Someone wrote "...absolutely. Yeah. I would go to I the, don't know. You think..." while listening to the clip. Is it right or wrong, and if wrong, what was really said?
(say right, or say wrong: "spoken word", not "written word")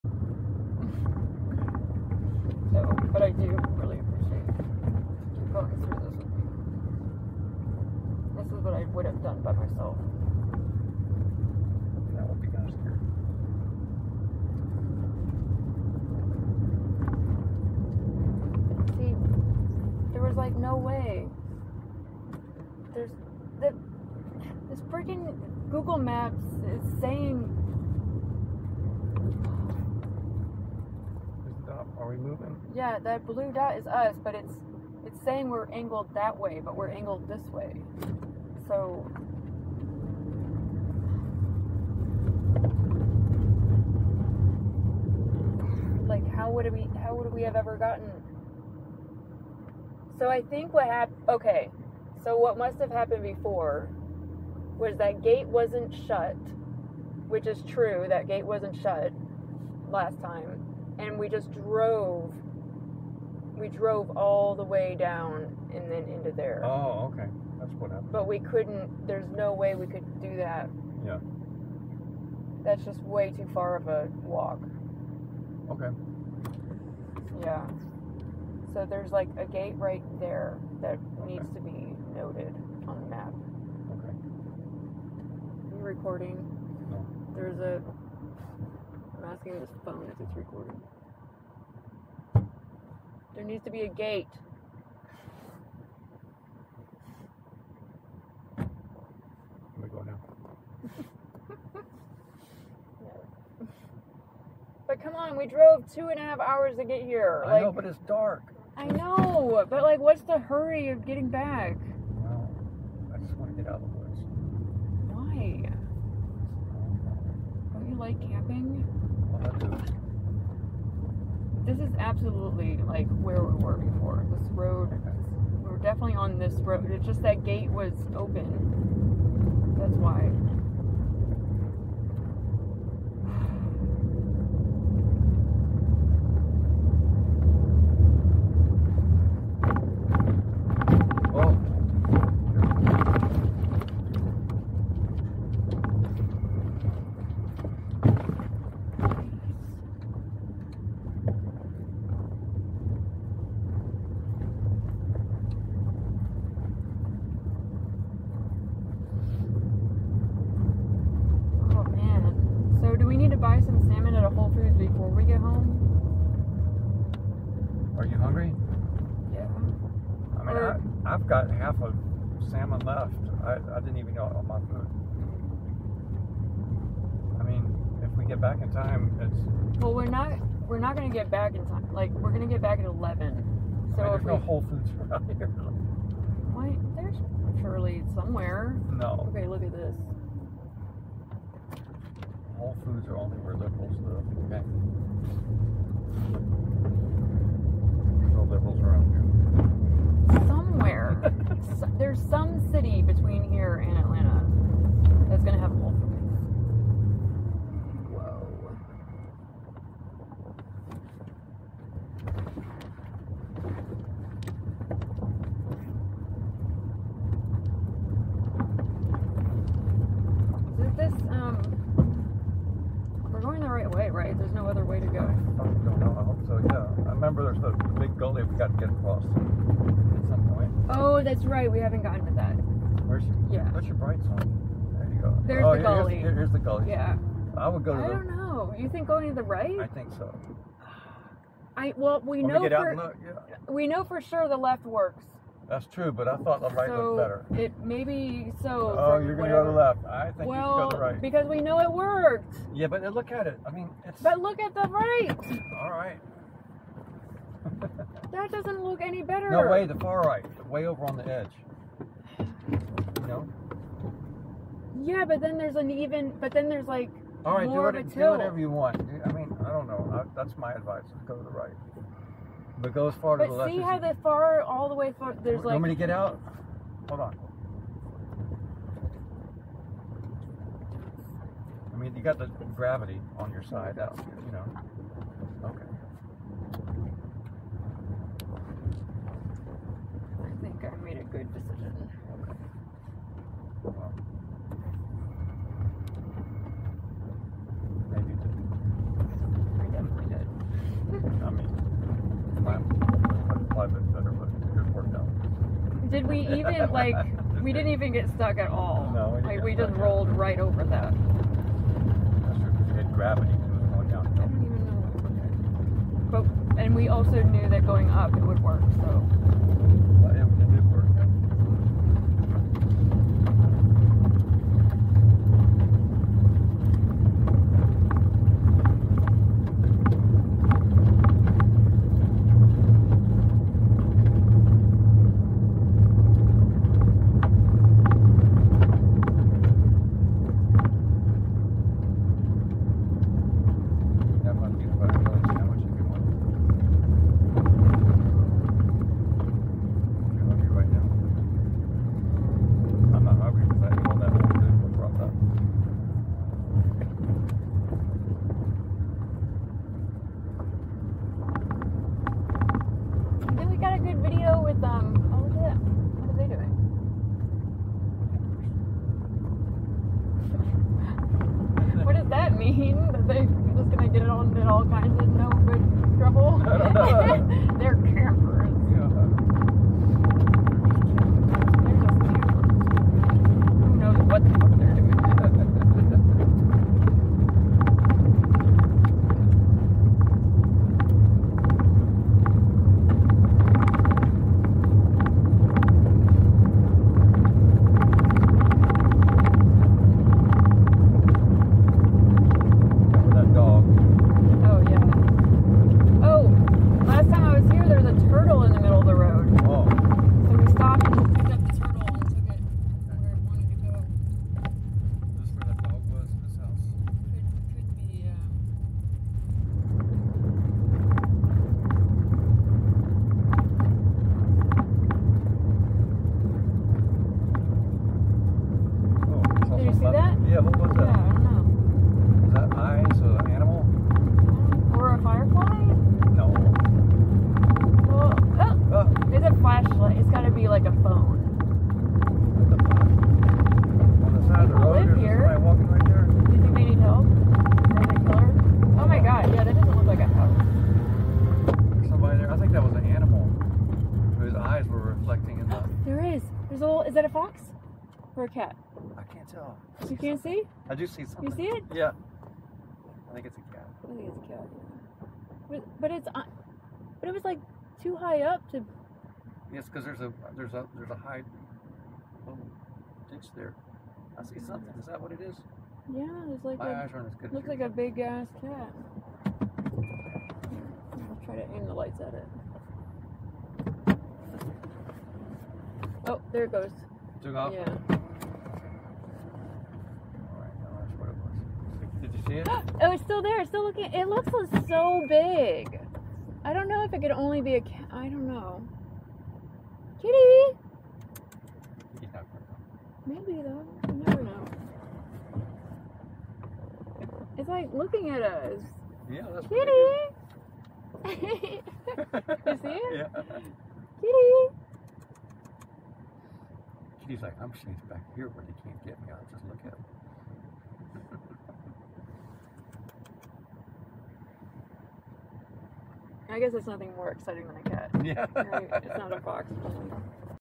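wrong: "gully", not "absolutely".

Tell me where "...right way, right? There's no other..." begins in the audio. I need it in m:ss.
3:43.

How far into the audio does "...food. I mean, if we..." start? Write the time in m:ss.
2:54.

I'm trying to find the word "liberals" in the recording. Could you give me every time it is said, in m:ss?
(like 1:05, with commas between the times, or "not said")
3:13, 3:18.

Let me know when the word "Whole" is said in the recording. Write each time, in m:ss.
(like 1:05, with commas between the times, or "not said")
3:04, 3:12.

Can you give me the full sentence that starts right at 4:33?
But see how the far, all the way far, there's you like.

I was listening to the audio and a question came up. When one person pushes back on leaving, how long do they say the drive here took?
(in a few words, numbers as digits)
two and a half hours.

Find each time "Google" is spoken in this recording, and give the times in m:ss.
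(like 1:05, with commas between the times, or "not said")
0:25.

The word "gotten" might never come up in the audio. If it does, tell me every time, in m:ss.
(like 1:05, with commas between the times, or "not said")
0:47, 3:52.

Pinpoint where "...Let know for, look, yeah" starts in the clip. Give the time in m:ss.
4:02.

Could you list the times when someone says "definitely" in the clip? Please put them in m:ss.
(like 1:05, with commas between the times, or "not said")
2:05.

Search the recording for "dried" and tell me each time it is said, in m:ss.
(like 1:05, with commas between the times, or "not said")
not said.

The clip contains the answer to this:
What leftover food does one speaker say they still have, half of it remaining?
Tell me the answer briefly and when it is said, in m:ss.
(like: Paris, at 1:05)
salmon, at 2:51.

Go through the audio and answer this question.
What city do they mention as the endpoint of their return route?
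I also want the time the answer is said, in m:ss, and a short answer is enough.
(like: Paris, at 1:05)
Atlanta, at 3:23.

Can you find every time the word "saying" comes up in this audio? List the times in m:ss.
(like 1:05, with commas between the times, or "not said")
0:27, 0:35.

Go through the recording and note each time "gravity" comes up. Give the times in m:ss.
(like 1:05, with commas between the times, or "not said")
4:42, 5:13.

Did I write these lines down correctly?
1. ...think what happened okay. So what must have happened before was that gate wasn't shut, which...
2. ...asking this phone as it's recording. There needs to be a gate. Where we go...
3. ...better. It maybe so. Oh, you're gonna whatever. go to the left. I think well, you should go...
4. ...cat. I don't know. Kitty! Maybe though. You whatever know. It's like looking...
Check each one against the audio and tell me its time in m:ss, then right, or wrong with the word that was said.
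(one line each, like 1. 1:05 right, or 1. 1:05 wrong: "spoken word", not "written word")
1. 0:50 right
2. 1:29 right
3. 4:07 right
4. 8:17 wrong: "never", not "whatever".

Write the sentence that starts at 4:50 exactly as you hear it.
think I made a good decision.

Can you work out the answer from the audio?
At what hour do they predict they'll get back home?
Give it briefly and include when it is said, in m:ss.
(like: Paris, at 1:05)
11, at 3:02.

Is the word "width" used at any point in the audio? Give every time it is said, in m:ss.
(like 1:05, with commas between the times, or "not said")
not said.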